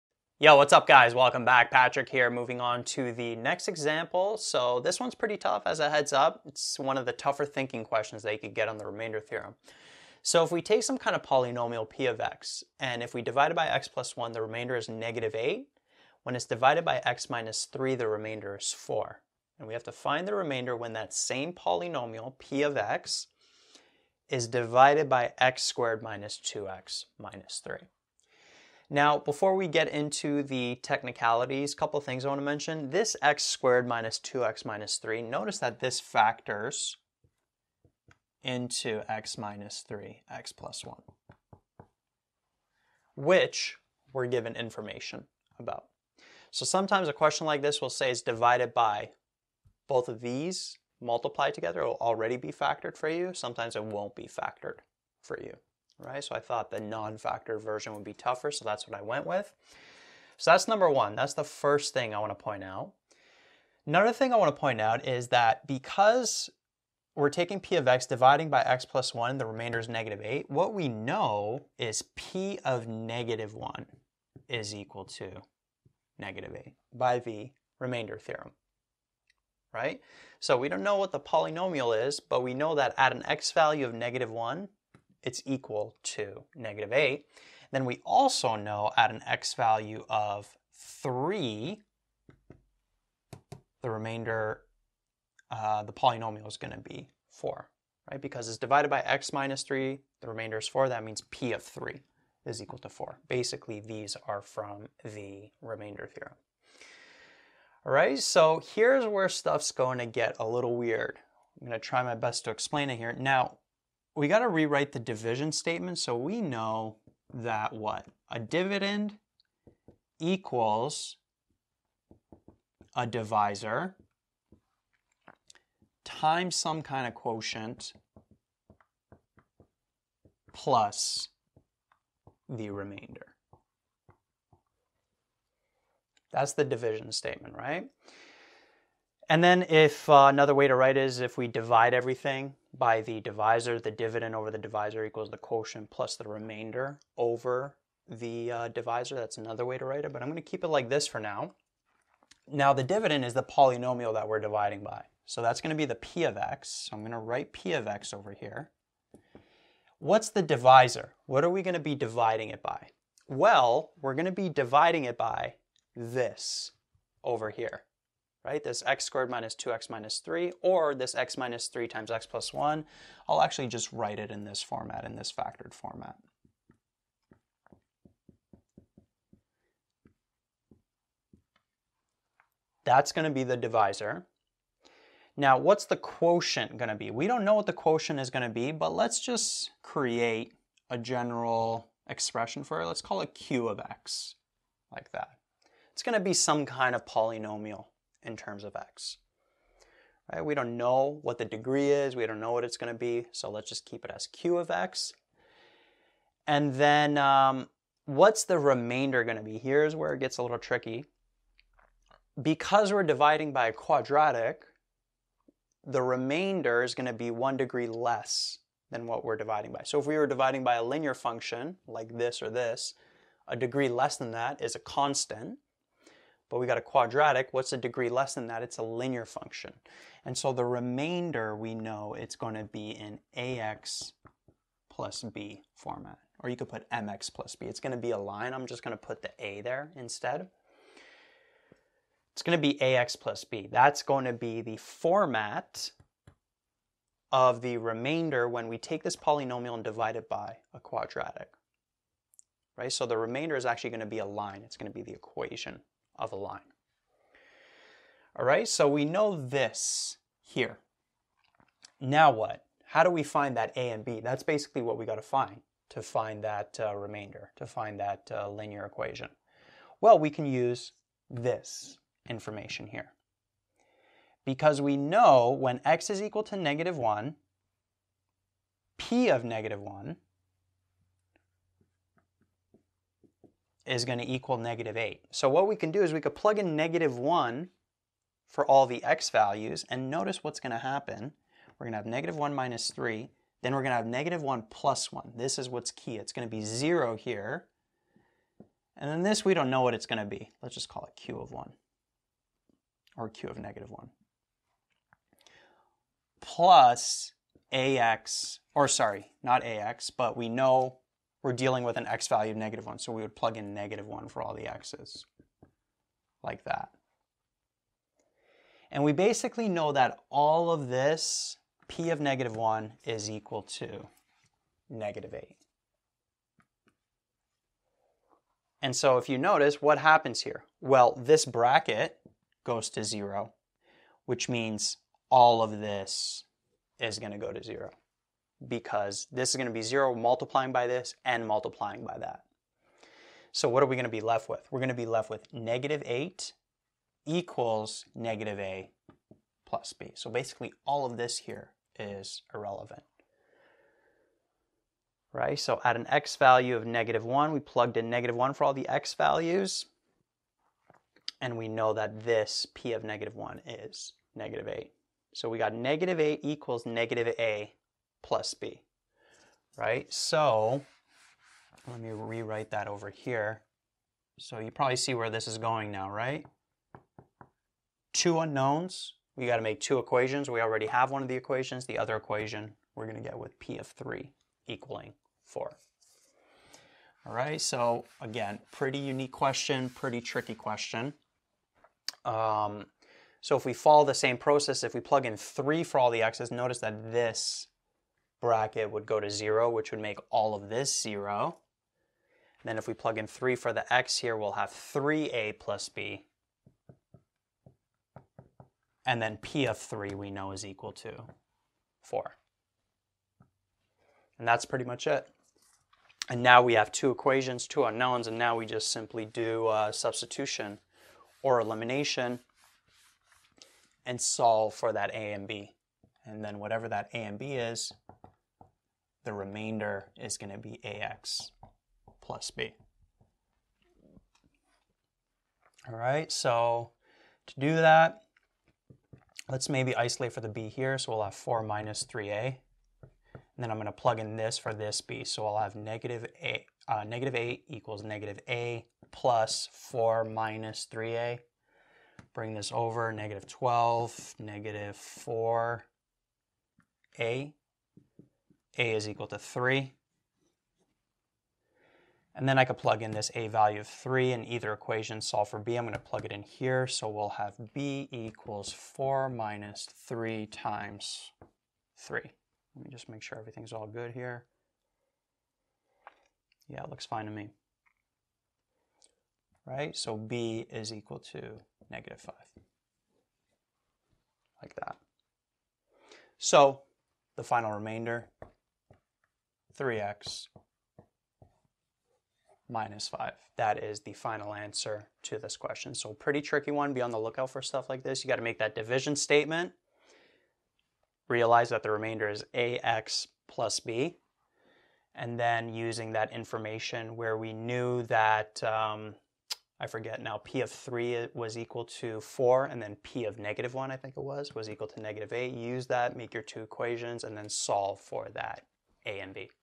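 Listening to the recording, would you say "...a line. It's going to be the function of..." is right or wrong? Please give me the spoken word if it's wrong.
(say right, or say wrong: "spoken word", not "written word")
wrong: "equation", not "function".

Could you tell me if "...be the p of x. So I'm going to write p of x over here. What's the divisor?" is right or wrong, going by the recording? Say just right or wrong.
right.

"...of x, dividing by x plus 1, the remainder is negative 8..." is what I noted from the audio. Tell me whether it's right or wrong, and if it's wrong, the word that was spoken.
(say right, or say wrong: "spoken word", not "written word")
right.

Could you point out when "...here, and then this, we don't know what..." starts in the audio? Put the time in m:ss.
4:57.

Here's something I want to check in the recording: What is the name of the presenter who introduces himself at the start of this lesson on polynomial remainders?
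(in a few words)
Patrick.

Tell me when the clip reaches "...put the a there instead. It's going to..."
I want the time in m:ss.
3:58.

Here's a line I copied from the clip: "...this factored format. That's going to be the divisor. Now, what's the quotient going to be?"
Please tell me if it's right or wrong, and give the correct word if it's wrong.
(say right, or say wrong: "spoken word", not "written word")
right.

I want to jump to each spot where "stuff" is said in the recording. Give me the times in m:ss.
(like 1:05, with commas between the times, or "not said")
1:49, 8:17.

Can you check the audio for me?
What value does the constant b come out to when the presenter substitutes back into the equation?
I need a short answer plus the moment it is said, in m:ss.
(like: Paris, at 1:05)
-5, at 8:01.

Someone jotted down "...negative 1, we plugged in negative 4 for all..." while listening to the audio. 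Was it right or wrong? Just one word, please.
wrong.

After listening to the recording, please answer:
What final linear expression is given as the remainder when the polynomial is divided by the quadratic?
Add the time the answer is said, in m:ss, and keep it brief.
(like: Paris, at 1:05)
3x - 5, at 8:09.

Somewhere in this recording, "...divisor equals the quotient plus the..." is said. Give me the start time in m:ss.
2:24.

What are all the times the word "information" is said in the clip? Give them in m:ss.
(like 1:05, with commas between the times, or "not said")
0:44, 4:32, 8:26.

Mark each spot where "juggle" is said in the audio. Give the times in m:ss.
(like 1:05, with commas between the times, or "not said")
not said.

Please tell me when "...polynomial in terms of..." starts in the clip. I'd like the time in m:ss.
3:17.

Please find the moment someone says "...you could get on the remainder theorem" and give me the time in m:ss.
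0:08.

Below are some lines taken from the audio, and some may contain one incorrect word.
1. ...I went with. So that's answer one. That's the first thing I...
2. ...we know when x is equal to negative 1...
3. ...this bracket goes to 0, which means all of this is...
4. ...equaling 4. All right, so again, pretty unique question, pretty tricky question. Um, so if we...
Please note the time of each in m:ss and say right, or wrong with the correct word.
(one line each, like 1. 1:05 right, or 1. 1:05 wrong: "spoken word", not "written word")
1. 0:58 wrong: "number", not "answer"
2. 4:34 right
3. 5:31 right
4. 6:24 right.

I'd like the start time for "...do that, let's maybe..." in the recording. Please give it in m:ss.
7:17.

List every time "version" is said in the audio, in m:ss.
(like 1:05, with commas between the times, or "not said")
0:57.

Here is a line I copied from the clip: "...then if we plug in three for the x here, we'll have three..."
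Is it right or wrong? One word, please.
right.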